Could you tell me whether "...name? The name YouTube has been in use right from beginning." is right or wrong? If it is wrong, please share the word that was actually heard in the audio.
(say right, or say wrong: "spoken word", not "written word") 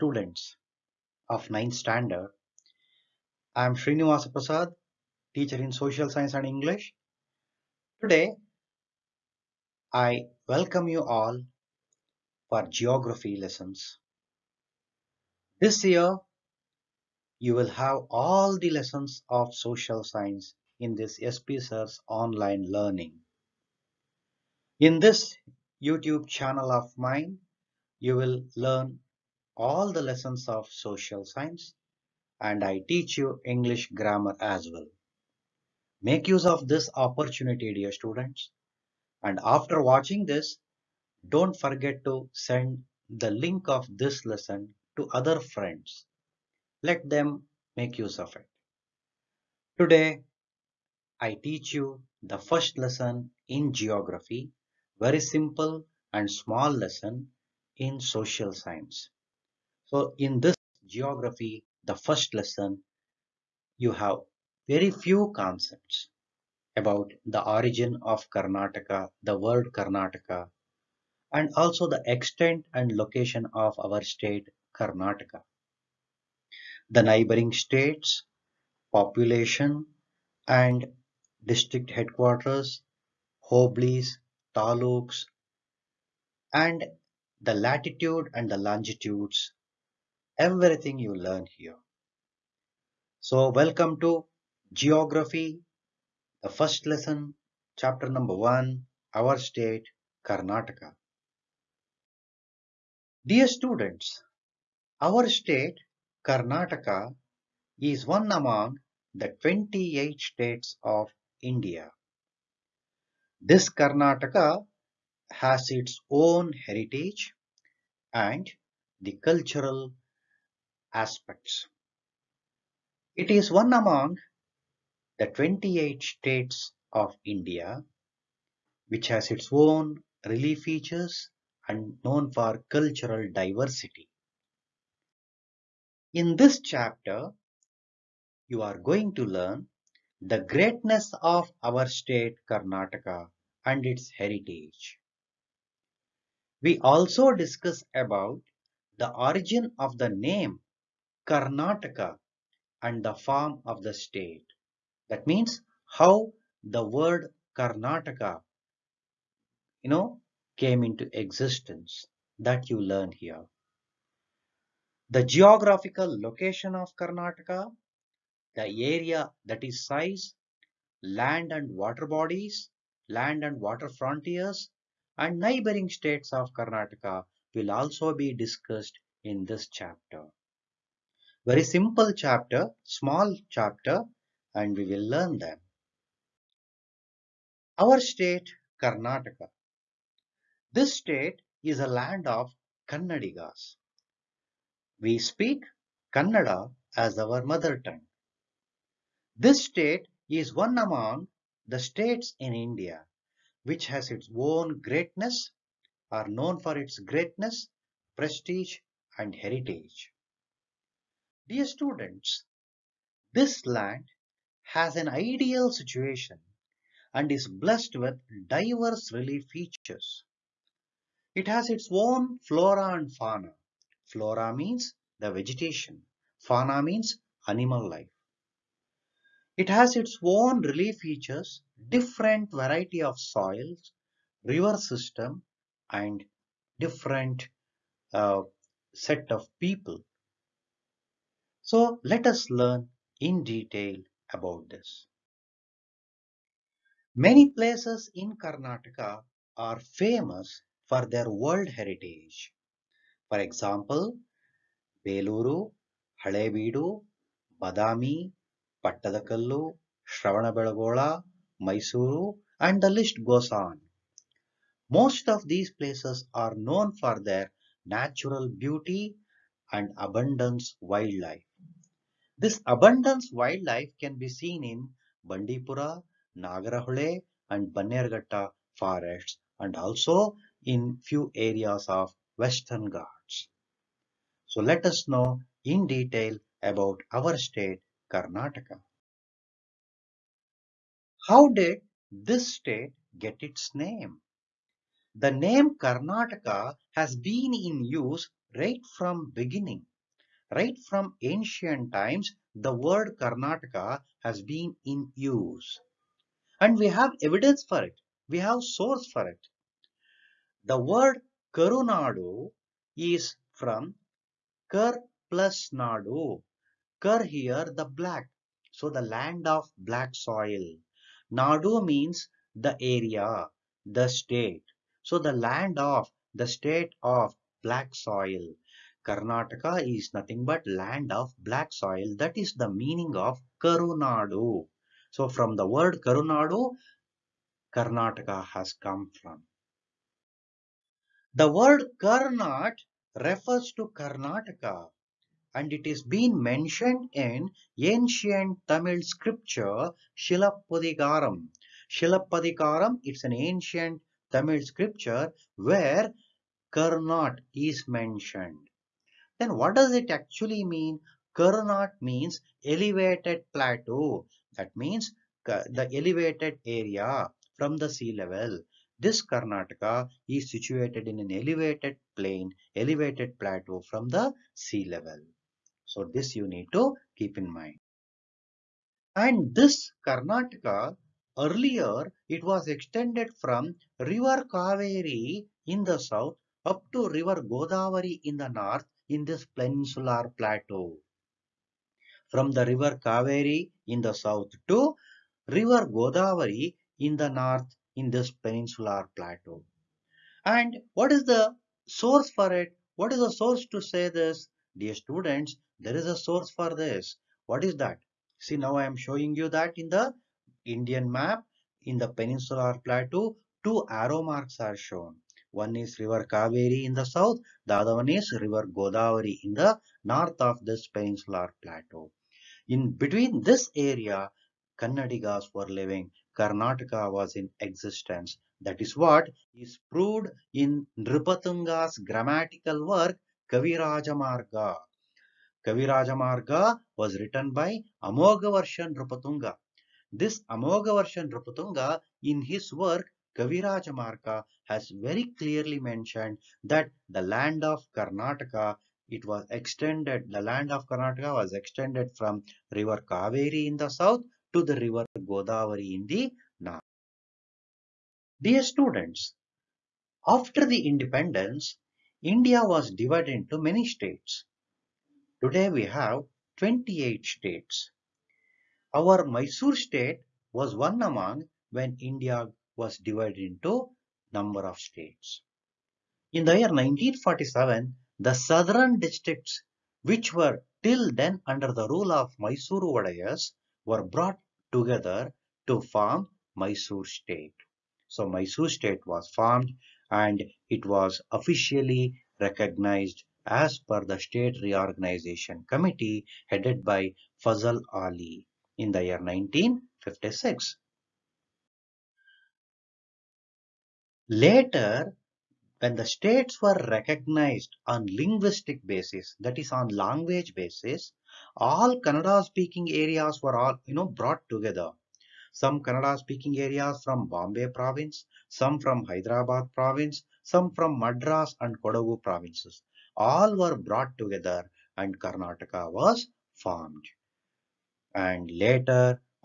wrong: "Karnataka", not "YouTube".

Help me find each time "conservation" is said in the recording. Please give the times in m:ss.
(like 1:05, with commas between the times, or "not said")
not said.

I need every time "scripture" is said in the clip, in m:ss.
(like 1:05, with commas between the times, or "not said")
5:49, 5:54.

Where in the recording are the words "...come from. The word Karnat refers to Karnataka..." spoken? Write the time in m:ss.
5:38.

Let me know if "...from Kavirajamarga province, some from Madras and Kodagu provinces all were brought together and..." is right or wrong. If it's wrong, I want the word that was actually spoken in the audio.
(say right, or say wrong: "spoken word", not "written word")
wrong: "Hyderabad", not "Kavirajamarga".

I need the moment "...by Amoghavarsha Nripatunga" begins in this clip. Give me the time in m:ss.
7:17.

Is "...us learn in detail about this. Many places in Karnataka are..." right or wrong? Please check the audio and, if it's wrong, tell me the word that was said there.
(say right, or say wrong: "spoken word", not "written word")
right.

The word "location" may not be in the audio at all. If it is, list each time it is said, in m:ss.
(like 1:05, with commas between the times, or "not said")
1:12, 2:46.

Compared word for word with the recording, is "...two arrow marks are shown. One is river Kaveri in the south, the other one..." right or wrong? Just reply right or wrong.
right.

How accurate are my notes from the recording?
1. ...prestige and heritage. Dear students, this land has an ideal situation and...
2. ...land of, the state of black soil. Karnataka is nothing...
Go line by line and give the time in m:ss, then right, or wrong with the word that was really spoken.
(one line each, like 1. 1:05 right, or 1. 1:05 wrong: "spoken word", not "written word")
1. 3:28 right
2. 5:25 right.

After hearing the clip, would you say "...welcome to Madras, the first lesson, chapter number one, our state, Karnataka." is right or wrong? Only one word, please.
wrong.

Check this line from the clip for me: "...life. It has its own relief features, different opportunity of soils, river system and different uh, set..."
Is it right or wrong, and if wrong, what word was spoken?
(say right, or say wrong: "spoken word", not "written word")
wrong: "variety", not "opportunity".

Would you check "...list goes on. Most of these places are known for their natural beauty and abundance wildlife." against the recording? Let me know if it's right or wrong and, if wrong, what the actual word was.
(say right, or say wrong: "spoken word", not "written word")
right.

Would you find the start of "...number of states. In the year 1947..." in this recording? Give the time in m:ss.
7:54.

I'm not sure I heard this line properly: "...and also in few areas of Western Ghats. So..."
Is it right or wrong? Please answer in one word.
right.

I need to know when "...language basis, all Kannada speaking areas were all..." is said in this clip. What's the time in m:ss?
8:29.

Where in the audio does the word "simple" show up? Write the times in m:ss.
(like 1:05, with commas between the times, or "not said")
0:55, 3:01.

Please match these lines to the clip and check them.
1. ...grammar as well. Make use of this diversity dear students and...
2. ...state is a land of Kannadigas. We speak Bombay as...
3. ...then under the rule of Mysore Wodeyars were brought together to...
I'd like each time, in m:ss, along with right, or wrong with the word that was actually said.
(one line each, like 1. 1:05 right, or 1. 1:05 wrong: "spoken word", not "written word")
1. 0:33 wrong: "opportunity", not "diversity"
2. 3:10 wrong: "Kannada", not "Bombay"
3. 8:01 right.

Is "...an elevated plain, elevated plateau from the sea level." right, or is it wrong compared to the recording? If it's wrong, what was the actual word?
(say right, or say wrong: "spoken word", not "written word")
right.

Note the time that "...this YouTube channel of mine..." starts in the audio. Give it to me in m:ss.
0:24.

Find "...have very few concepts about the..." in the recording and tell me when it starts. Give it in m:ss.
1:03.